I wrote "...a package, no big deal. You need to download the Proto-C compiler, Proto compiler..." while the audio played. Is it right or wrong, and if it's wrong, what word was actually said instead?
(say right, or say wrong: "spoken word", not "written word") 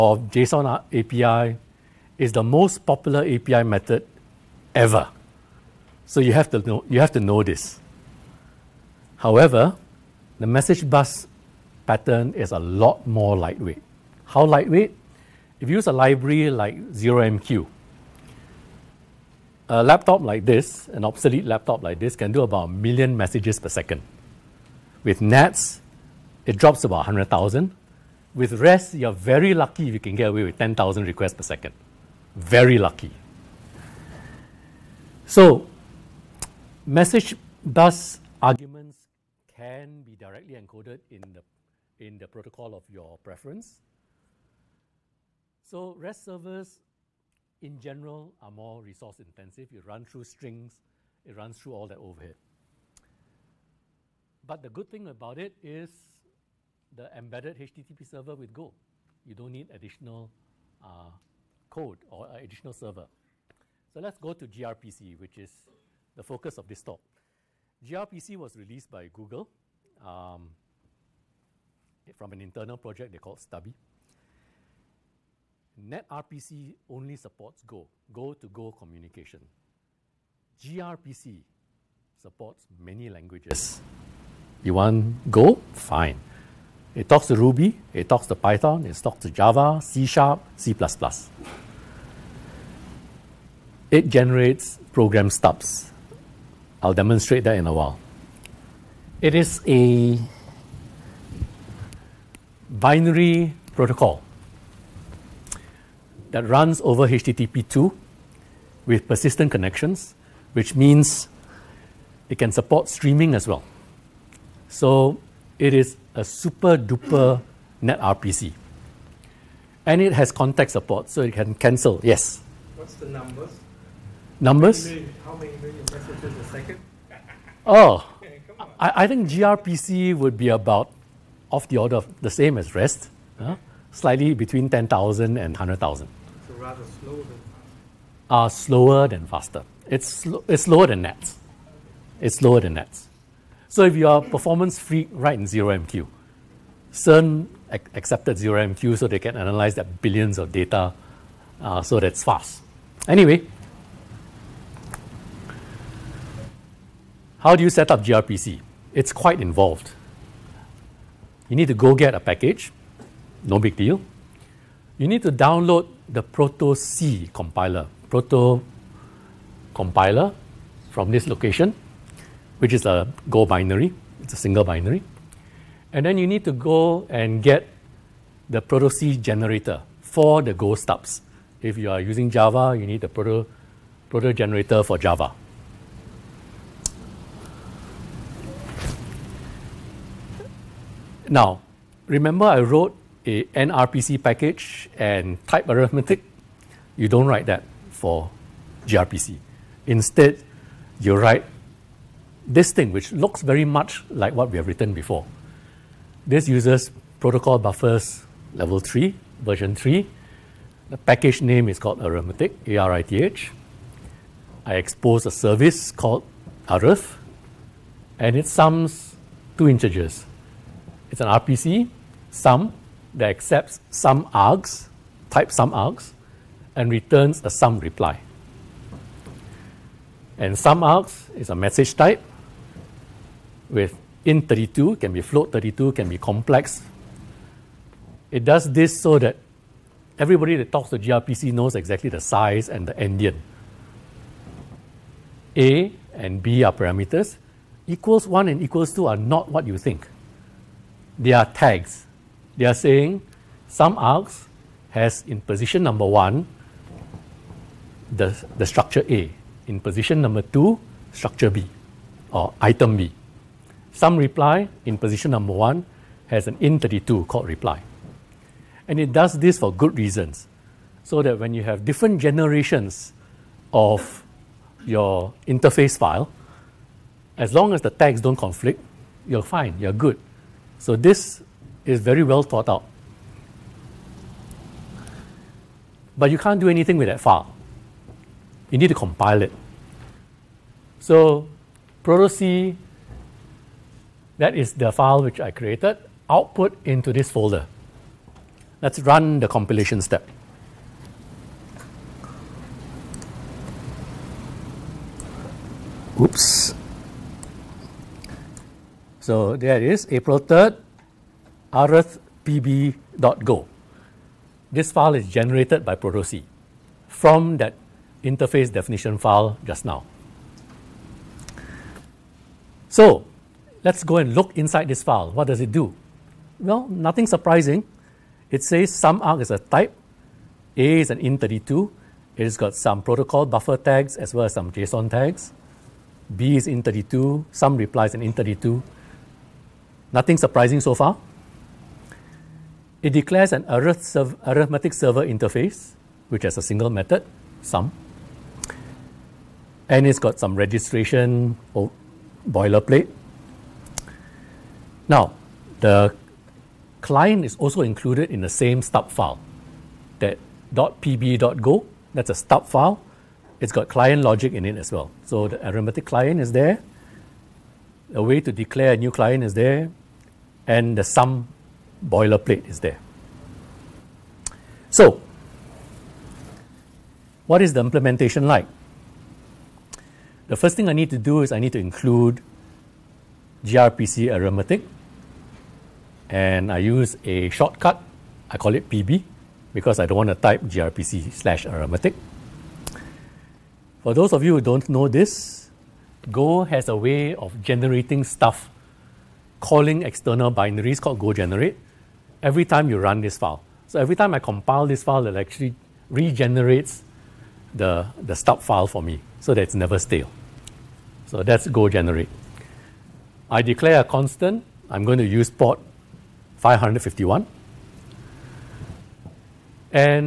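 right.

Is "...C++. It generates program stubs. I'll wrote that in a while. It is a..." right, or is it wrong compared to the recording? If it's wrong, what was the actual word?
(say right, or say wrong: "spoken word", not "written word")
wrong: "demonstrate", not "wrote".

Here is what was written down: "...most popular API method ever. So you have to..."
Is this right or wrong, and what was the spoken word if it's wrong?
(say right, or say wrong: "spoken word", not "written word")
right.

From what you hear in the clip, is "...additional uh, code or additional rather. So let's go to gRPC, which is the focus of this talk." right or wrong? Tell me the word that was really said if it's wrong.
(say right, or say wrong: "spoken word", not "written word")
wrong: "server", not "rather".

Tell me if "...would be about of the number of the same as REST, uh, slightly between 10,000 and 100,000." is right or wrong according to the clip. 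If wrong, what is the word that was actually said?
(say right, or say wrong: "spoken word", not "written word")
wrong: "order", not "number".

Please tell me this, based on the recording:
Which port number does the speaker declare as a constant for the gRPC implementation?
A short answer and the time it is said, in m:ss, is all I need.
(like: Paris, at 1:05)
551, at 6:56.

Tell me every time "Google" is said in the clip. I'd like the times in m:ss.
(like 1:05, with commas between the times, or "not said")
1:09.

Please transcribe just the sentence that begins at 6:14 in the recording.
So, what is the implementation like?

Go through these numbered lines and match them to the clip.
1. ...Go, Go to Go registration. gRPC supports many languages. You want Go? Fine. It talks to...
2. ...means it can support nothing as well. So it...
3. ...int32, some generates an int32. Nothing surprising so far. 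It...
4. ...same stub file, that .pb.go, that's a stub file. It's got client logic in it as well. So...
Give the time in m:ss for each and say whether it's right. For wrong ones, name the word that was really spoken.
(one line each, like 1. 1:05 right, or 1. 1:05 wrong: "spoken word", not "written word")
1. 1:17 wrong: "communication", not "registration"
2. 1:50 wrong: "streaming", not "nothing"
3. 5:36 wrong: "replies", not "generates"
4. 5:58 right.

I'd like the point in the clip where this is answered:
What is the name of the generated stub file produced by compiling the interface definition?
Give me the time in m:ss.
5:11.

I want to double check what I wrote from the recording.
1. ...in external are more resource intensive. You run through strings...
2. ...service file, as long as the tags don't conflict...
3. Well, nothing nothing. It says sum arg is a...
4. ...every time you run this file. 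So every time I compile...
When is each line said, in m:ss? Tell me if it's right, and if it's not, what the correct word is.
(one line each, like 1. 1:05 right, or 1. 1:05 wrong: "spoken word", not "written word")
1. 0:47 wrong: "general", not "external"
2. 4:35 wrong: "interface", not "service"
3. 5:26 wrong: "surprising", not "nothing"
4. 6:42 right.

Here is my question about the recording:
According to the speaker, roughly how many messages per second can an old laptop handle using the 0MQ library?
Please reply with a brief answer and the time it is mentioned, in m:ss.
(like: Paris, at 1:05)
1,000,000, at 0:22.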